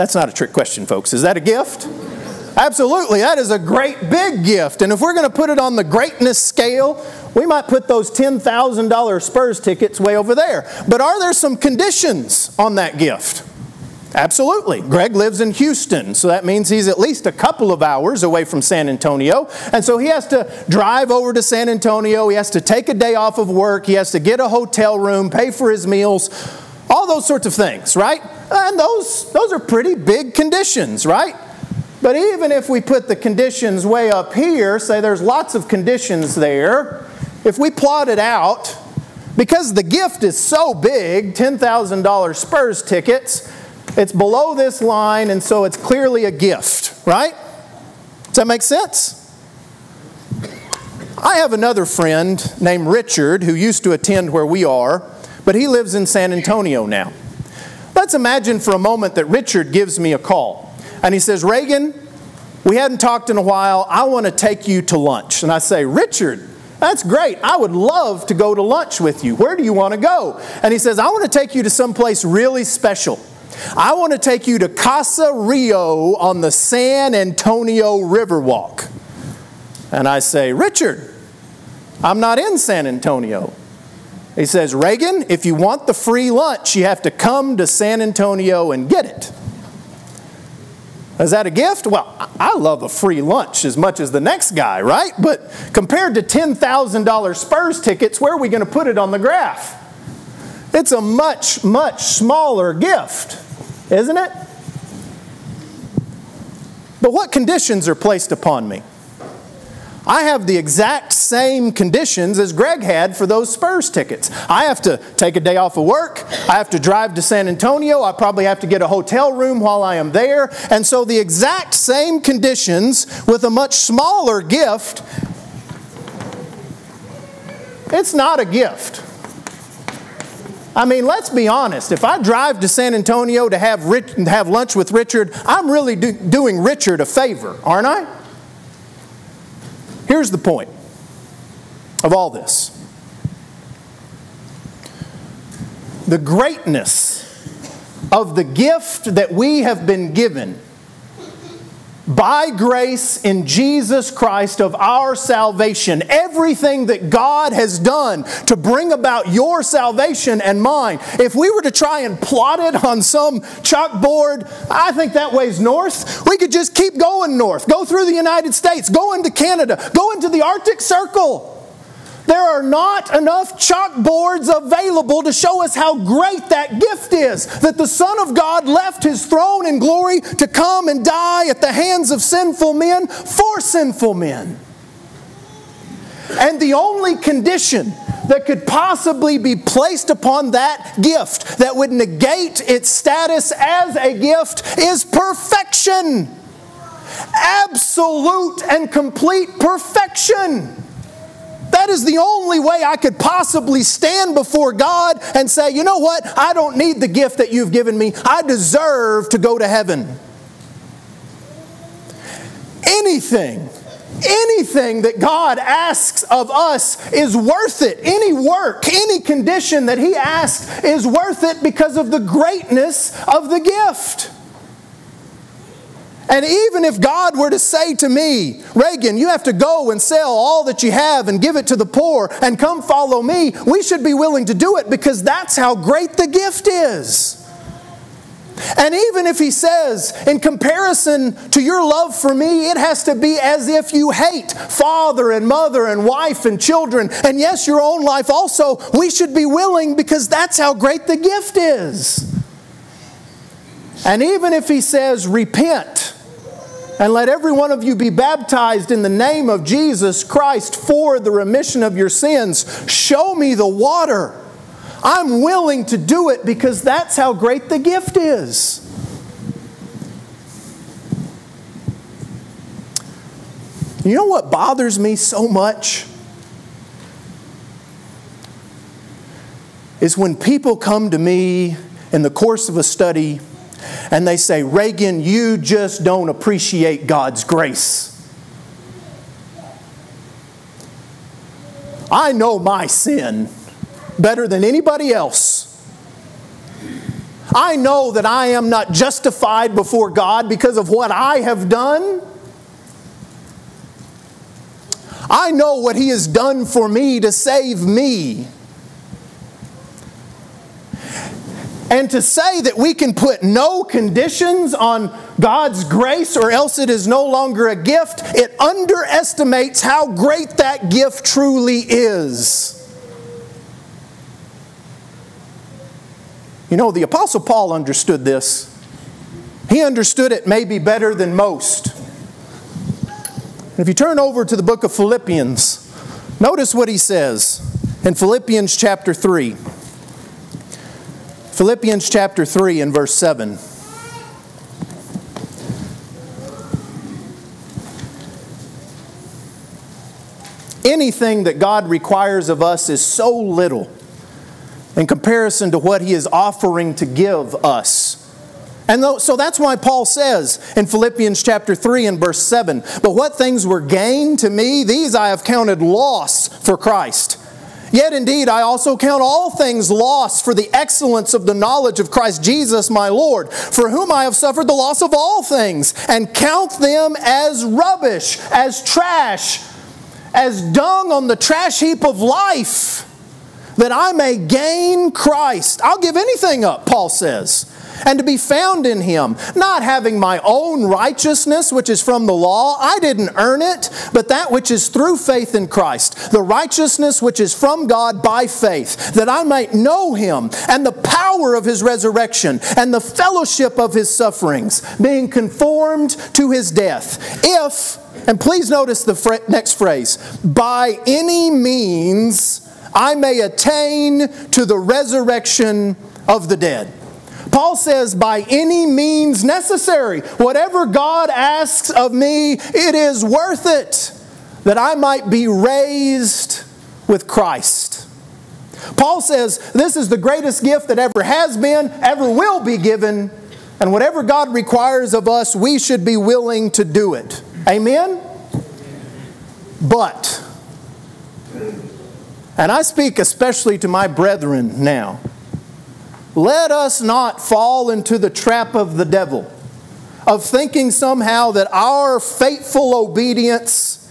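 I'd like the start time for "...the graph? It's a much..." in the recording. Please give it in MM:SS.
01:39.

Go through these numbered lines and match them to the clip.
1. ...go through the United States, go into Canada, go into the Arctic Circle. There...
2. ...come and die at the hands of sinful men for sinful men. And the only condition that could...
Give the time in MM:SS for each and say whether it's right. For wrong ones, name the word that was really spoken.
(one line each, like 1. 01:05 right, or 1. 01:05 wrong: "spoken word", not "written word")
1. 02:47 right
2. 03:00 right.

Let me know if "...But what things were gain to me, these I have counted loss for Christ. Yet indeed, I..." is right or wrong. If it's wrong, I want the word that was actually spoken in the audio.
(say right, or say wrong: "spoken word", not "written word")
right.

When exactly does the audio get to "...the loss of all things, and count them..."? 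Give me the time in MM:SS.
06:14.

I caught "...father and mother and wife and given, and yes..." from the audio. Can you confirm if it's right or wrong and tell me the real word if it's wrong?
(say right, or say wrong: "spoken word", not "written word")
wrong: "children", not "given".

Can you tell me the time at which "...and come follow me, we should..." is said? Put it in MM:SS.
03:52.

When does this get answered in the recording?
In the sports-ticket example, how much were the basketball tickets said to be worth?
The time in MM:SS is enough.
00:41.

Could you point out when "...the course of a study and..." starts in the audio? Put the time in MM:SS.
04:42.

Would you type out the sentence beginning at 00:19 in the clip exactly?
And so he has to drive over to San Antonio.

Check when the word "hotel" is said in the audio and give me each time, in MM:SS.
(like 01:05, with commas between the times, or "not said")
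00:24, 01:58.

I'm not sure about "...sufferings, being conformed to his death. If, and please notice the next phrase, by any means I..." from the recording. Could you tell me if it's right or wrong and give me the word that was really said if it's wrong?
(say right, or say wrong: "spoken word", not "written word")
right.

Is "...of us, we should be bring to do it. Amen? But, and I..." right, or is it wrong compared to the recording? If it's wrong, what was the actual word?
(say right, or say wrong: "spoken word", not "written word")
wrong: "willing", not "bring".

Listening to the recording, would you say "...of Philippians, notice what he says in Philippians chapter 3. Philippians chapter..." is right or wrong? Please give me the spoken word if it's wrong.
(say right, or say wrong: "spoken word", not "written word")
right.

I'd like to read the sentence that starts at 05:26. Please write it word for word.
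You know, the Apostle Paul understood this.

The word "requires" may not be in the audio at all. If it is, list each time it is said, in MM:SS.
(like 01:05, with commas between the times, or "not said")
05:51, 07:14.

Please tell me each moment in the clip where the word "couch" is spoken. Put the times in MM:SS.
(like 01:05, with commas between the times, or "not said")
not said.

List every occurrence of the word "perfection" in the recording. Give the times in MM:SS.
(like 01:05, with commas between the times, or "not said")
03:15, 03:19.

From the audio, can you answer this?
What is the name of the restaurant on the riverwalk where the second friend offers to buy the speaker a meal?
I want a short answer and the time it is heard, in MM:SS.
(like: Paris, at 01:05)
Casa Rio, at 01:14.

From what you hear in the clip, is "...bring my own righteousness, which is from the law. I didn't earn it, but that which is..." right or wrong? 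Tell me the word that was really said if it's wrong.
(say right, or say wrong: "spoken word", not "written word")
wrong: "having", not "bring".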